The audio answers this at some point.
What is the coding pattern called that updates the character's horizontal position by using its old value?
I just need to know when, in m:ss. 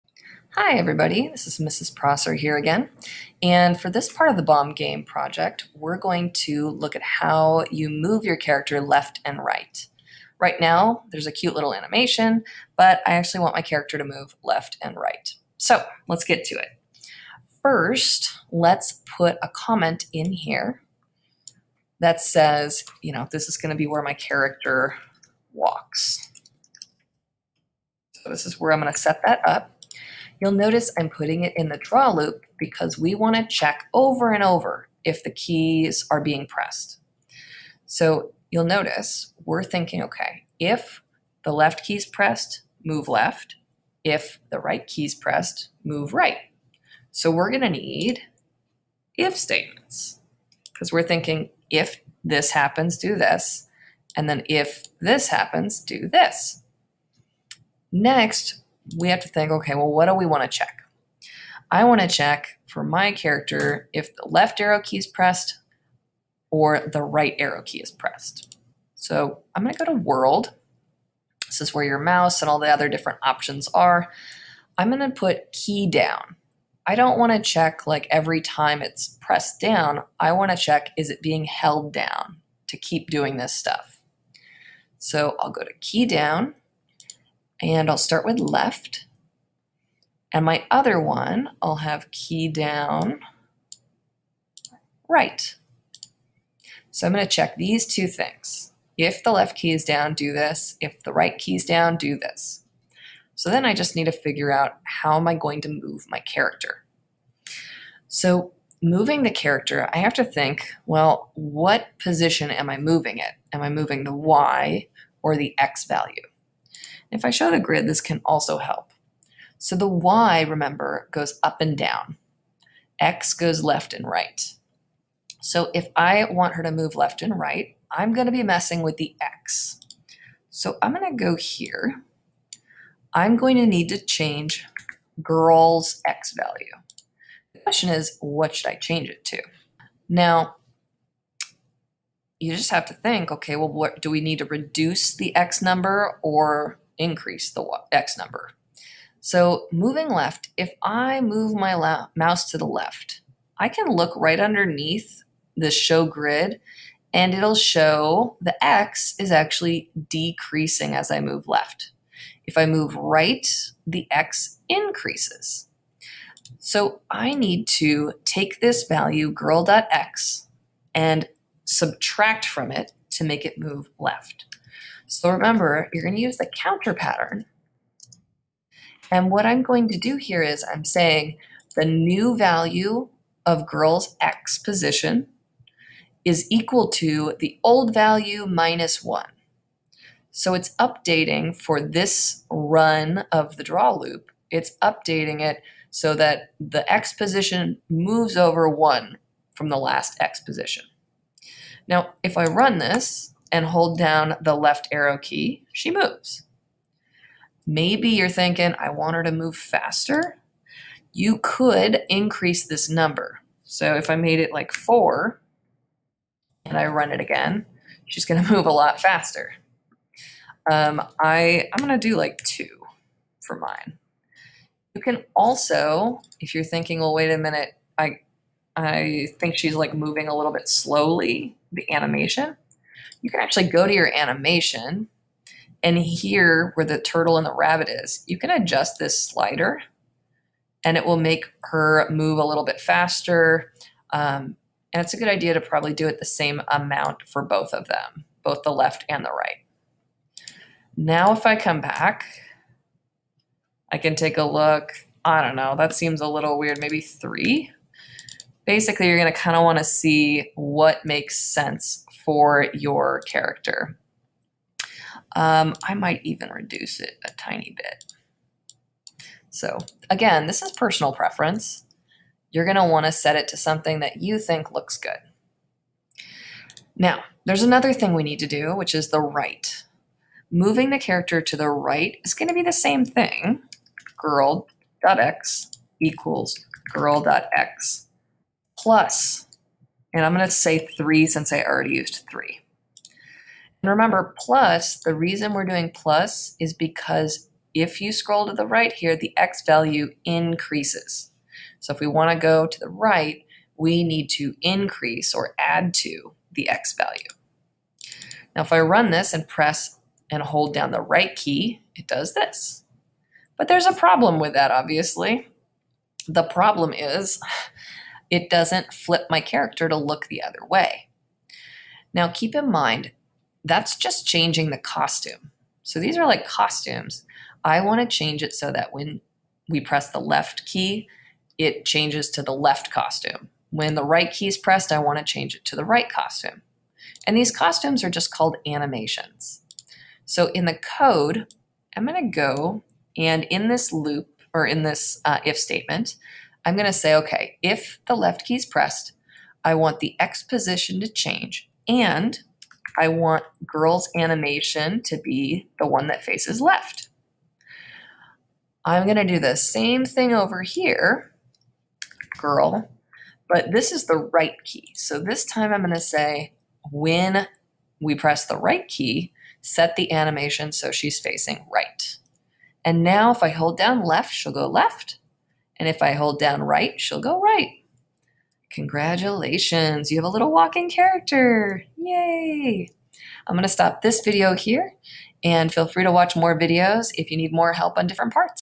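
2:56.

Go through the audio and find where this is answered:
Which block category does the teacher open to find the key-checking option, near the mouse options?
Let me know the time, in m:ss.
1:09.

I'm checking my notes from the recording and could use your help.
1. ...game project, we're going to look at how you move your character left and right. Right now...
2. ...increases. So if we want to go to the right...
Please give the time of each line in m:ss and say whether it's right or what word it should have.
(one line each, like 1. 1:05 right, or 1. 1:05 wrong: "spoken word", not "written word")
1. 0:04 right
2. 5:00 right.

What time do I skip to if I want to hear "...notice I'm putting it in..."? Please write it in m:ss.
0:30.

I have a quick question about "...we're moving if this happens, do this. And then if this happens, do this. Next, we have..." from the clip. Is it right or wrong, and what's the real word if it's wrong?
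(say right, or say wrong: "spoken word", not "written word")
wrong: "thinking", not "moving".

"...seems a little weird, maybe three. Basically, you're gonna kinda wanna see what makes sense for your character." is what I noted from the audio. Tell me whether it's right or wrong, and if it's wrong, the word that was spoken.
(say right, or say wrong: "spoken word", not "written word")
right.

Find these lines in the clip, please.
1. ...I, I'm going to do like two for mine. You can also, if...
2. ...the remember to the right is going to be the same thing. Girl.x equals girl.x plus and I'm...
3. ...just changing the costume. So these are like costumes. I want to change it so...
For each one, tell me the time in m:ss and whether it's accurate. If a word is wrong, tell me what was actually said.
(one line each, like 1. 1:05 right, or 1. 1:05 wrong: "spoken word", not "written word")
1. 3:41 right
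2. 4:40 wrong: "character", not "remember"
3. 5:23 right.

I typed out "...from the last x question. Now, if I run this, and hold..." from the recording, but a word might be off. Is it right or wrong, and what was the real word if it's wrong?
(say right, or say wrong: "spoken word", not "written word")
wrong: "position", not "question".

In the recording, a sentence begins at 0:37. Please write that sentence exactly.
So you'll notice we're thinking, okay, if the left key is pressed, move left.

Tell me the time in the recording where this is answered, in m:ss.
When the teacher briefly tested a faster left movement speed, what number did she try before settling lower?
3:34.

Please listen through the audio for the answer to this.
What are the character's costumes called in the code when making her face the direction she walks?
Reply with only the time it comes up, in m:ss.
5:38.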